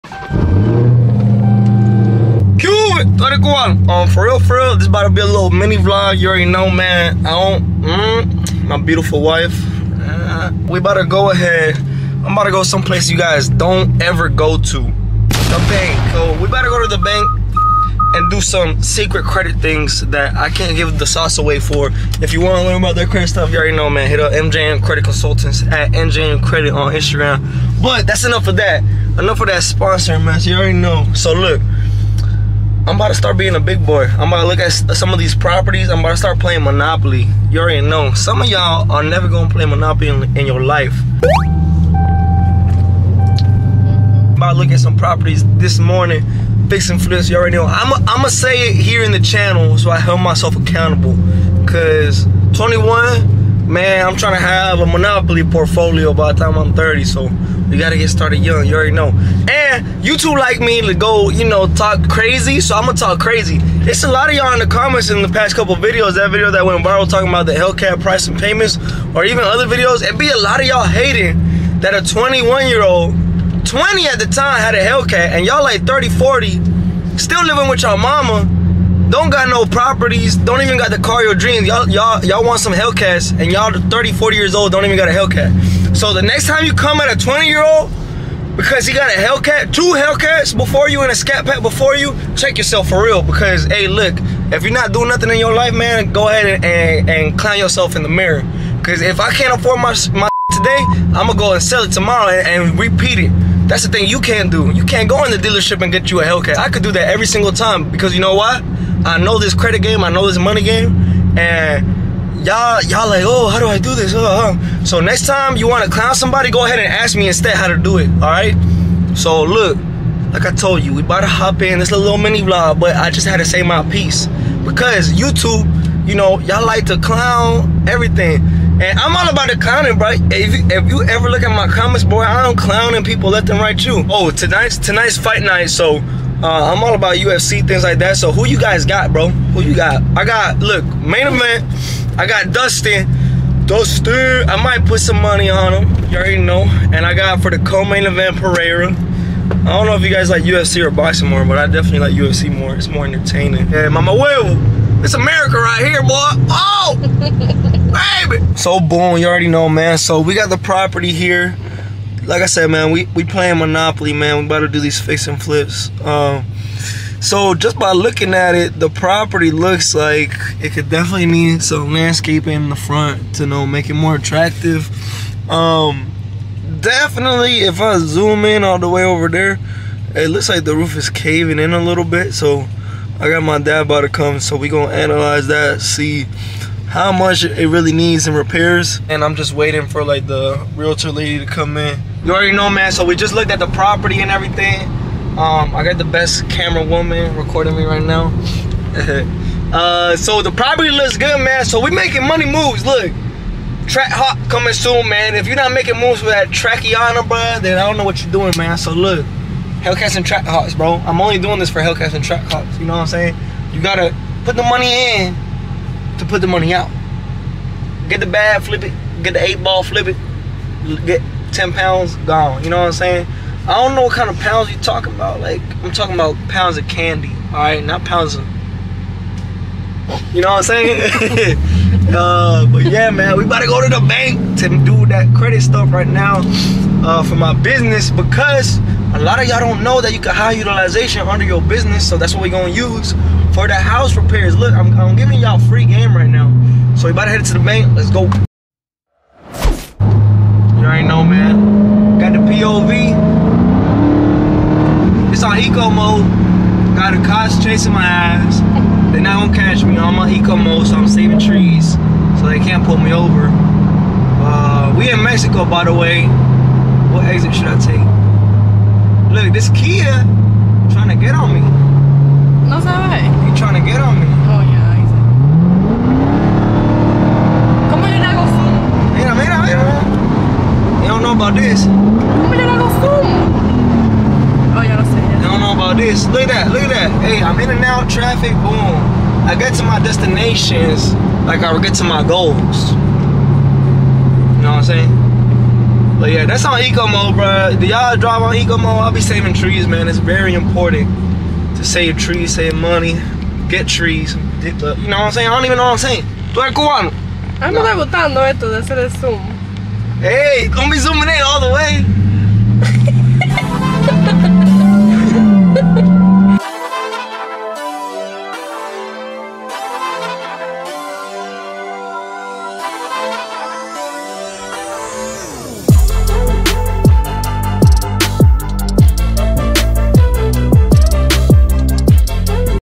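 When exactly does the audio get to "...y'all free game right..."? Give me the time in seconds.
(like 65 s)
245 s.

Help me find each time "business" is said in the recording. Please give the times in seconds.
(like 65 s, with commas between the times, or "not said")
237 s, 241 s.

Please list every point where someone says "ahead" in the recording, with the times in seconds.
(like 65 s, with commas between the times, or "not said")
11 s, 96 s, 116 s.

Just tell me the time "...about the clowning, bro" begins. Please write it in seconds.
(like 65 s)
129 s.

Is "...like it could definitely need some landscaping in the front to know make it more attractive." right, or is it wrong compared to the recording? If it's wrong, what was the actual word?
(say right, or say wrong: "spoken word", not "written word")
right.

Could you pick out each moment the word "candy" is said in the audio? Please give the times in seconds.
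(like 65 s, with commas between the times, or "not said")
226 s.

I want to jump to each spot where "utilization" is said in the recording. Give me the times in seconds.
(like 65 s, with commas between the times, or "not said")
240 s.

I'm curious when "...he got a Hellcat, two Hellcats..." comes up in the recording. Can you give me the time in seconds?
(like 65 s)
88 s.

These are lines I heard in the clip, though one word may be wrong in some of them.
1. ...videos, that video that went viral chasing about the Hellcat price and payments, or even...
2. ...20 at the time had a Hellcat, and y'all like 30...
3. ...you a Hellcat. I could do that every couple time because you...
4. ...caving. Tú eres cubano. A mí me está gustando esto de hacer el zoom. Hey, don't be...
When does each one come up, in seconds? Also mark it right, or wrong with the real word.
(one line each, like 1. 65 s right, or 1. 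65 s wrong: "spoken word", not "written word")
1. 65 s wrong: "talking", not "chasing"
2. 73 s right
3. 106 s wrong: "single", not "couple"
4. 305 s wrong: "saying", not "caving".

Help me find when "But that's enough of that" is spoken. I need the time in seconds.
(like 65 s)
27 s.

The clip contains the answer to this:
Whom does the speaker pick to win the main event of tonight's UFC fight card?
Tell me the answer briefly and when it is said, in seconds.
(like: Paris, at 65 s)
Dustin, at 142 s.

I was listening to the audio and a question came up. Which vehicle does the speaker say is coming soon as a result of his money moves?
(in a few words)
Track Hawk.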